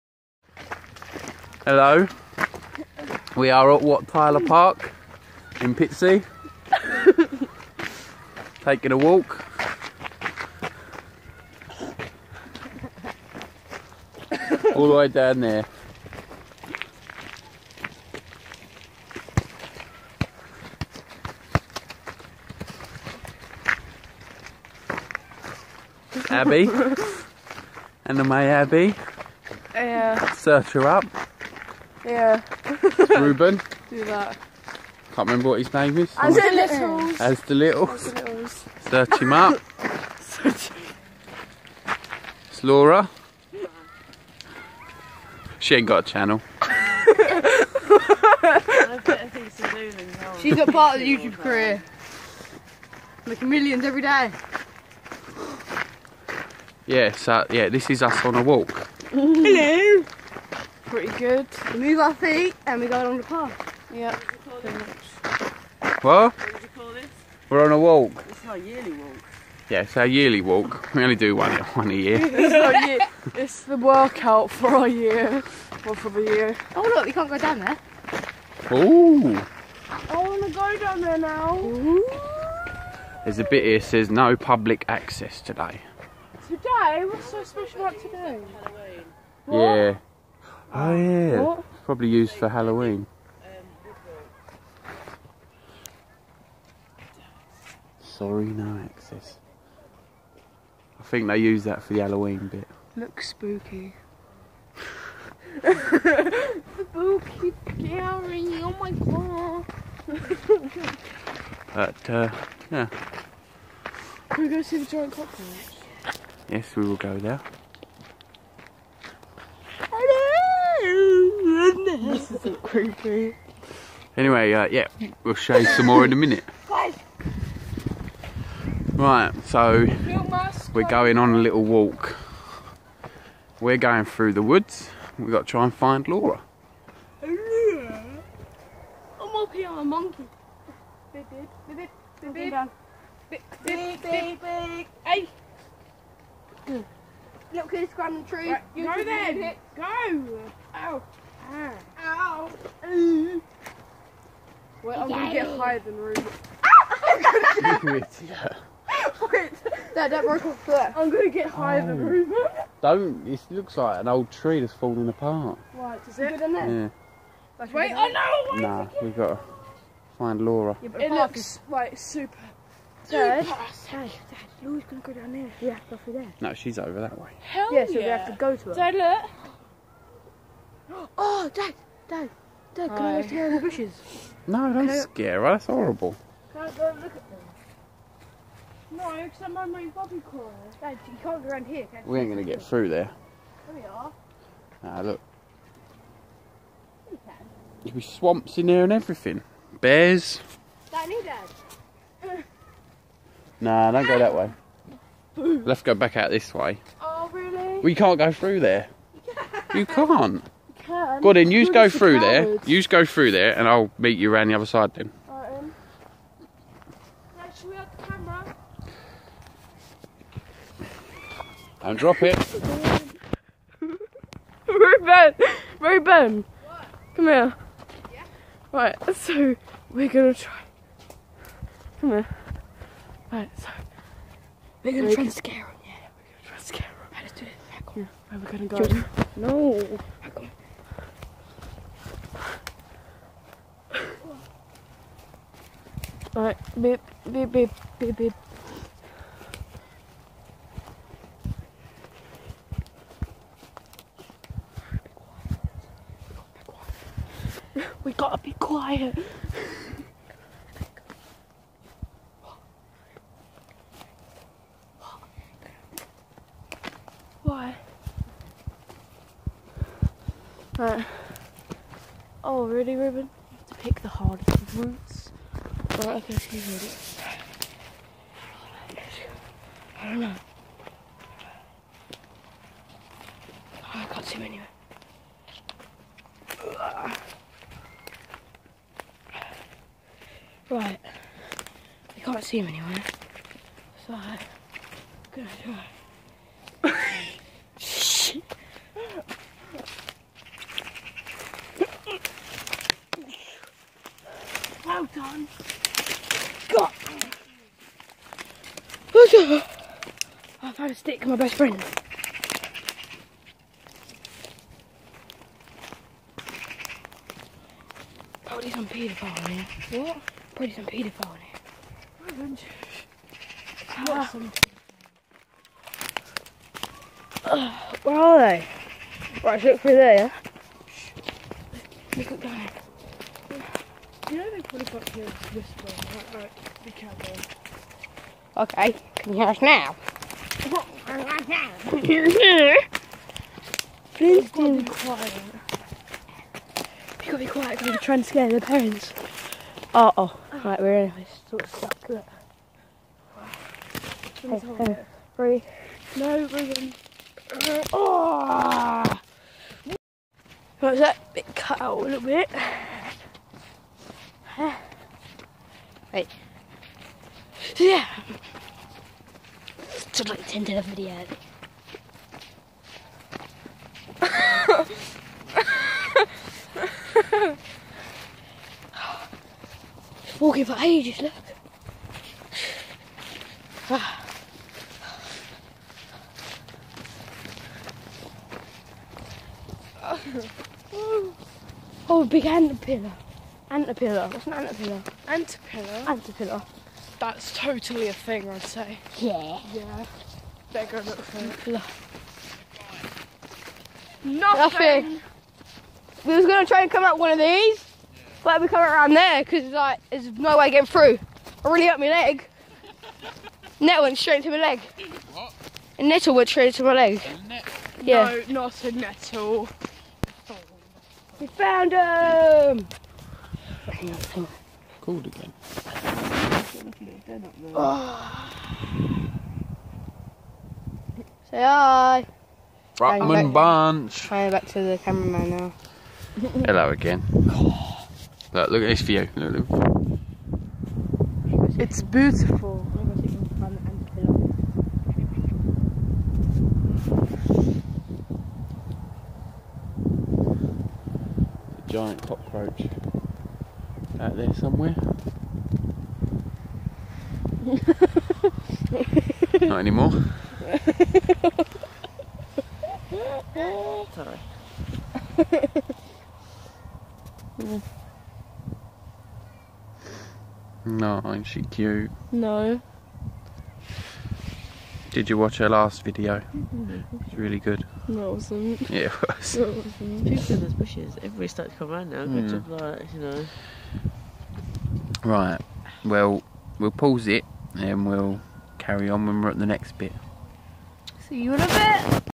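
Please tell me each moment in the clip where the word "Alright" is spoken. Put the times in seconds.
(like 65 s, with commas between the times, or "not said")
246 s, 270 s.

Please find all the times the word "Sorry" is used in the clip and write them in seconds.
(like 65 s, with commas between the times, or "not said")
98 s, 464 s.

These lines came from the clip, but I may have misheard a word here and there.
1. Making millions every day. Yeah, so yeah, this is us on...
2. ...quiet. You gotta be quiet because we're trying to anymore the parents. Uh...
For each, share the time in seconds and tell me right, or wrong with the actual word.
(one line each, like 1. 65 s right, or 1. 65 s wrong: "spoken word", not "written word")
1. 53 s right
2. 344 s wrong: "scare", not "anymore".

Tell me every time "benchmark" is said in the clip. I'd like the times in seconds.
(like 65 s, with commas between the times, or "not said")
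not said.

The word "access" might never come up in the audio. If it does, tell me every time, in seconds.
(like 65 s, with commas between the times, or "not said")
84 s, 98 s.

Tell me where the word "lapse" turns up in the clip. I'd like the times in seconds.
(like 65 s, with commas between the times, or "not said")
not said.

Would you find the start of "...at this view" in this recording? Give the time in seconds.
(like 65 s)
438 s.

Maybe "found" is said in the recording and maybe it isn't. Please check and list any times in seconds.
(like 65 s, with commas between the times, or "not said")
310 s, 421 s.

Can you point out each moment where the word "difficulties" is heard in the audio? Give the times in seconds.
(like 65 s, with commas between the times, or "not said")
not said.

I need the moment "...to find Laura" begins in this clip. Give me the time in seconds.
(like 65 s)
169 s.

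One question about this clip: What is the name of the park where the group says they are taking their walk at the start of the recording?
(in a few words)
Wat Tyler Park.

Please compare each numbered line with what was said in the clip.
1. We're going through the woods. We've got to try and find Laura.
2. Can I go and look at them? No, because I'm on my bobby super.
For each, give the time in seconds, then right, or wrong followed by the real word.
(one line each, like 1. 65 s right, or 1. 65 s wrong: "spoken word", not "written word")
1. 133 s right
2. 186 s wrong: "crawler", not "super".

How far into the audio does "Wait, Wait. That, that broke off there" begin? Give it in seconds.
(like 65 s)
157 s.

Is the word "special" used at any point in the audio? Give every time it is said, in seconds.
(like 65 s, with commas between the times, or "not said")
87 s.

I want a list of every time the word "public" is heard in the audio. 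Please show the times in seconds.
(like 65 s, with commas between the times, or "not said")
84 s.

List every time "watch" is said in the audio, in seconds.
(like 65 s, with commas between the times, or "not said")
475 s.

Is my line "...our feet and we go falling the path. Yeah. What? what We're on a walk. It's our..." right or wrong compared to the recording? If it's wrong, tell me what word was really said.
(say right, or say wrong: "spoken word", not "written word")
wrong: "along", not "falling".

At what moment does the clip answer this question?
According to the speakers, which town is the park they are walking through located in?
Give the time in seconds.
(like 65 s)
5 s.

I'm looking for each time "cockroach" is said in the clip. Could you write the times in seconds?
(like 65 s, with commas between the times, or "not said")
115 s, 452 s.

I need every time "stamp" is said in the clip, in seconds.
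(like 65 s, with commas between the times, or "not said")
not said.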